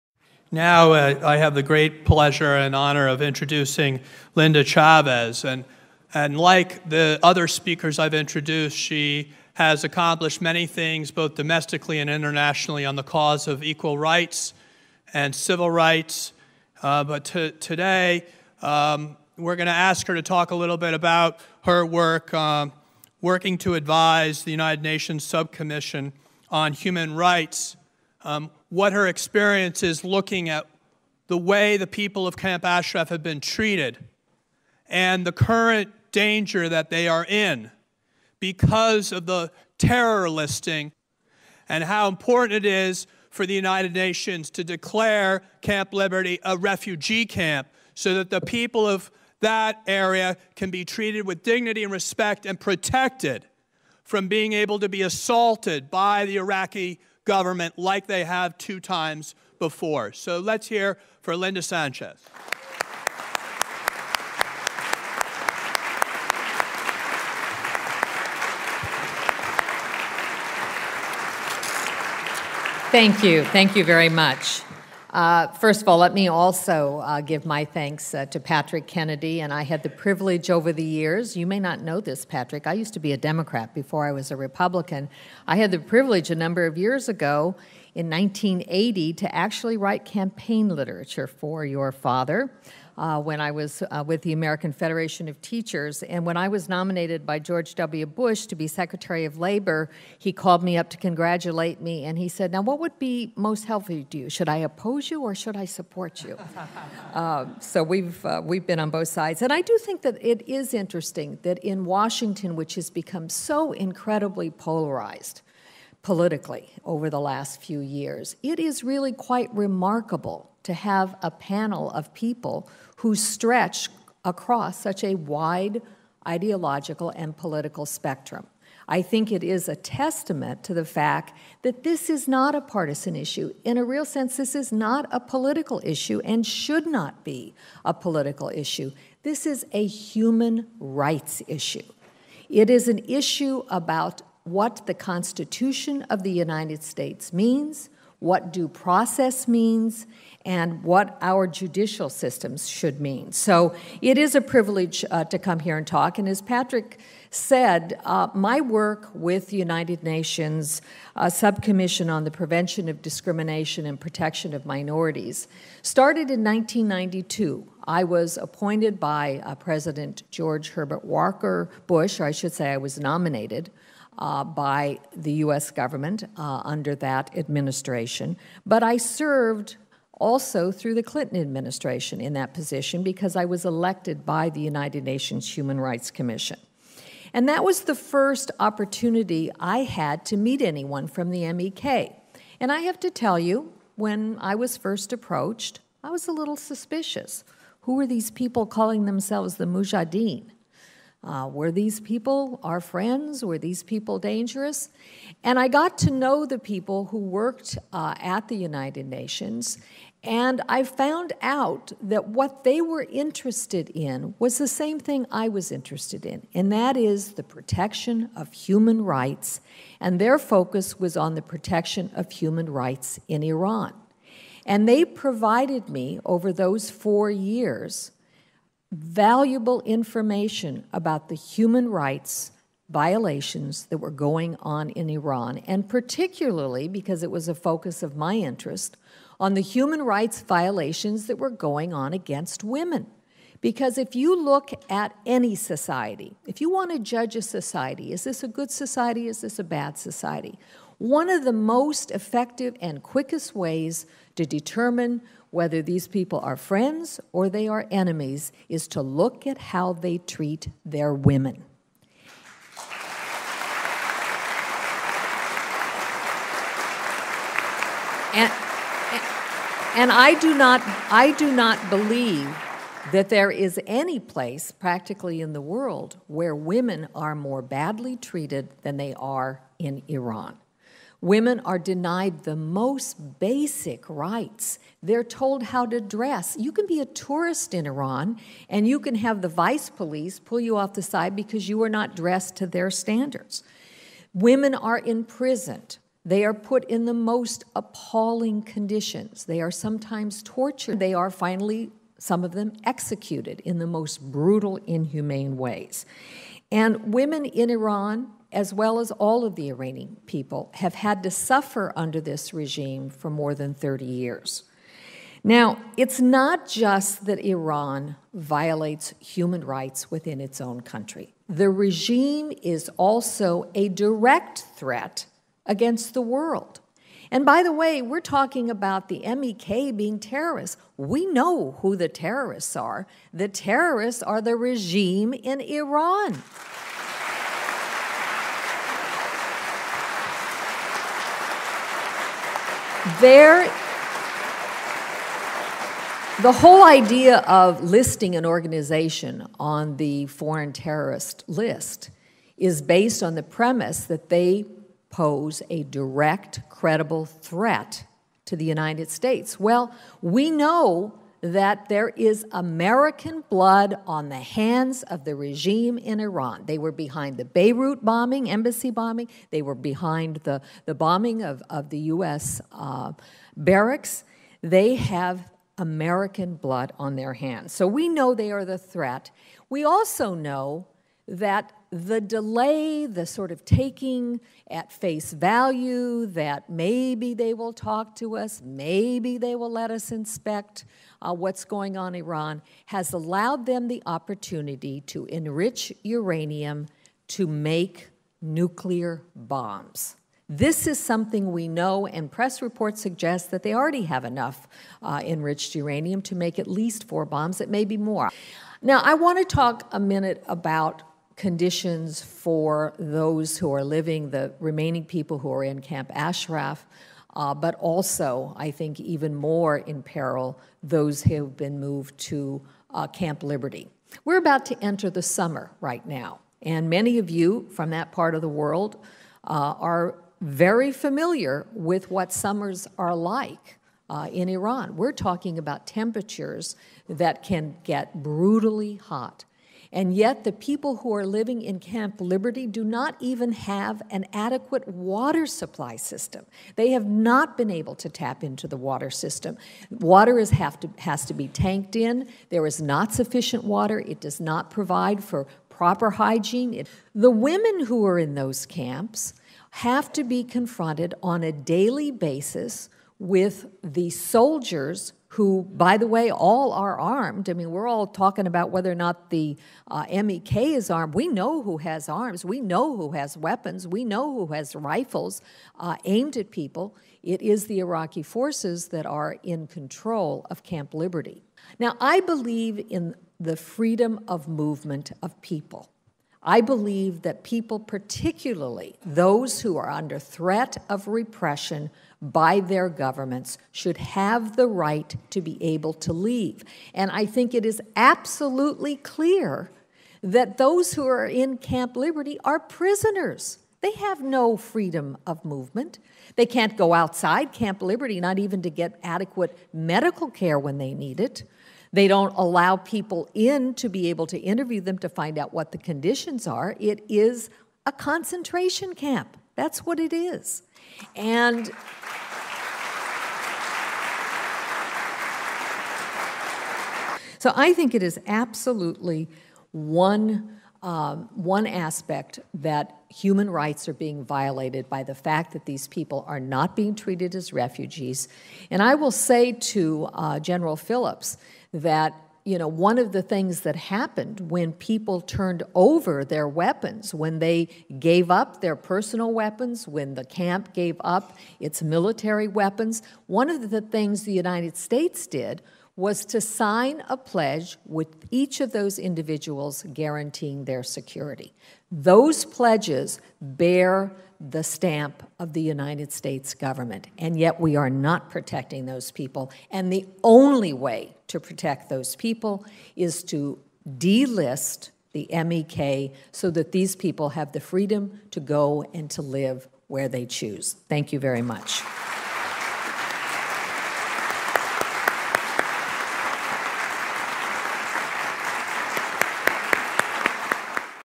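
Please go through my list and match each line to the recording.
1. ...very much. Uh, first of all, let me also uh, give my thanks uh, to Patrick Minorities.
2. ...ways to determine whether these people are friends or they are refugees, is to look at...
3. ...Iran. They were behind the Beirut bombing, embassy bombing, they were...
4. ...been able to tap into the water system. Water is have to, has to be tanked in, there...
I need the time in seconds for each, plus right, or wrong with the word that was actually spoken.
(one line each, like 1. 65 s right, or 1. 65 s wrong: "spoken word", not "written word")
1. 73 s wrong: "Kennedy", not "Minorities"
2. 253 s wrong: "enemies", not "refugees"
3. 366 s right
4. 447 s right.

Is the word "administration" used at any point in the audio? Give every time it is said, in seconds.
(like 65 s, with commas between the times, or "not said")
177 s, 181 s.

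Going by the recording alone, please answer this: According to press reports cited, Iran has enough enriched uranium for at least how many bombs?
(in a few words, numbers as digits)
4.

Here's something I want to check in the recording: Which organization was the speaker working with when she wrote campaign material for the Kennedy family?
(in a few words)
American Federation of Teachers.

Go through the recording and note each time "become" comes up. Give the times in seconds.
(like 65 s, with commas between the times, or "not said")
112 s.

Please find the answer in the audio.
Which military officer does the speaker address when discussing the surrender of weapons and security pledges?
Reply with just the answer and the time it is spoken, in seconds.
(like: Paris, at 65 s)
General Phillips, at 540 s.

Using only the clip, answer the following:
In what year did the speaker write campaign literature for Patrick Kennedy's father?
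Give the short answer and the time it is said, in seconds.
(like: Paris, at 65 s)
1980, at 88 s.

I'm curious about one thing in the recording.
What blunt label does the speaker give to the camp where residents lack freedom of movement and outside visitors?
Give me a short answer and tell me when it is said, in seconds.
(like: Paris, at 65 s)
A concentration camp, at 517 s.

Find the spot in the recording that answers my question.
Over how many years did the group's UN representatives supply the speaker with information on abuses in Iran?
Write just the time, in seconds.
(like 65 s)
226 s.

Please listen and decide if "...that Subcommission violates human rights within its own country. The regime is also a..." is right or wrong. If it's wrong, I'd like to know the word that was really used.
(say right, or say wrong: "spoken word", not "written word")
wrong: "Iran", not "Subcommission".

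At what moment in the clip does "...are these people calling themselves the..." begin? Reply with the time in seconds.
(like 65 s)
197 s.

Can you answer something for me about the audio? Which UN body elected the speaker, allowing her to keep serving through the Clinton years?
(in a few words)
United Nations Human Rights Commission.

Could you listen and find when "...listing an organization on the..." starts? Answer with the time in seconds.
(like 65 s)
347 s.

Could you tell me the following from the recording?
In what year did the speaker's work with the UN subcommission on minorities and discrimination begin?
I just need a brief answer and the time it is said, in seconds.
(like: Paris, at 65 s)
1992, at 166 s.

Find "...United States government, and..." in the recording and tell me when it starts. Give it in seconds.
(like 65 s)
565 s.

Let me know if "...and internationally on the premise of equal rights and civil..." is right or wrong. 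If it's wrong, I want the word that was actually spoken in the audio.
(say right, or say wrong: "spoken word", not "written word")
wrong: "cause", not "premise".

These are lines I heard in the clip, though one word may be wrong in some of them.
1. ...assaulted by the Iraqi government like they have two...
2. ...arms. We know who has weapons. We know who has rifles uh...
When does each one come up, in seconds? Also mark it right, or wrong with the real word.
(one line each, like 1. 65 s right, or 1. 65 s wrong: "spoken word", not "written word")
1. 55 s right
2. 472 s right.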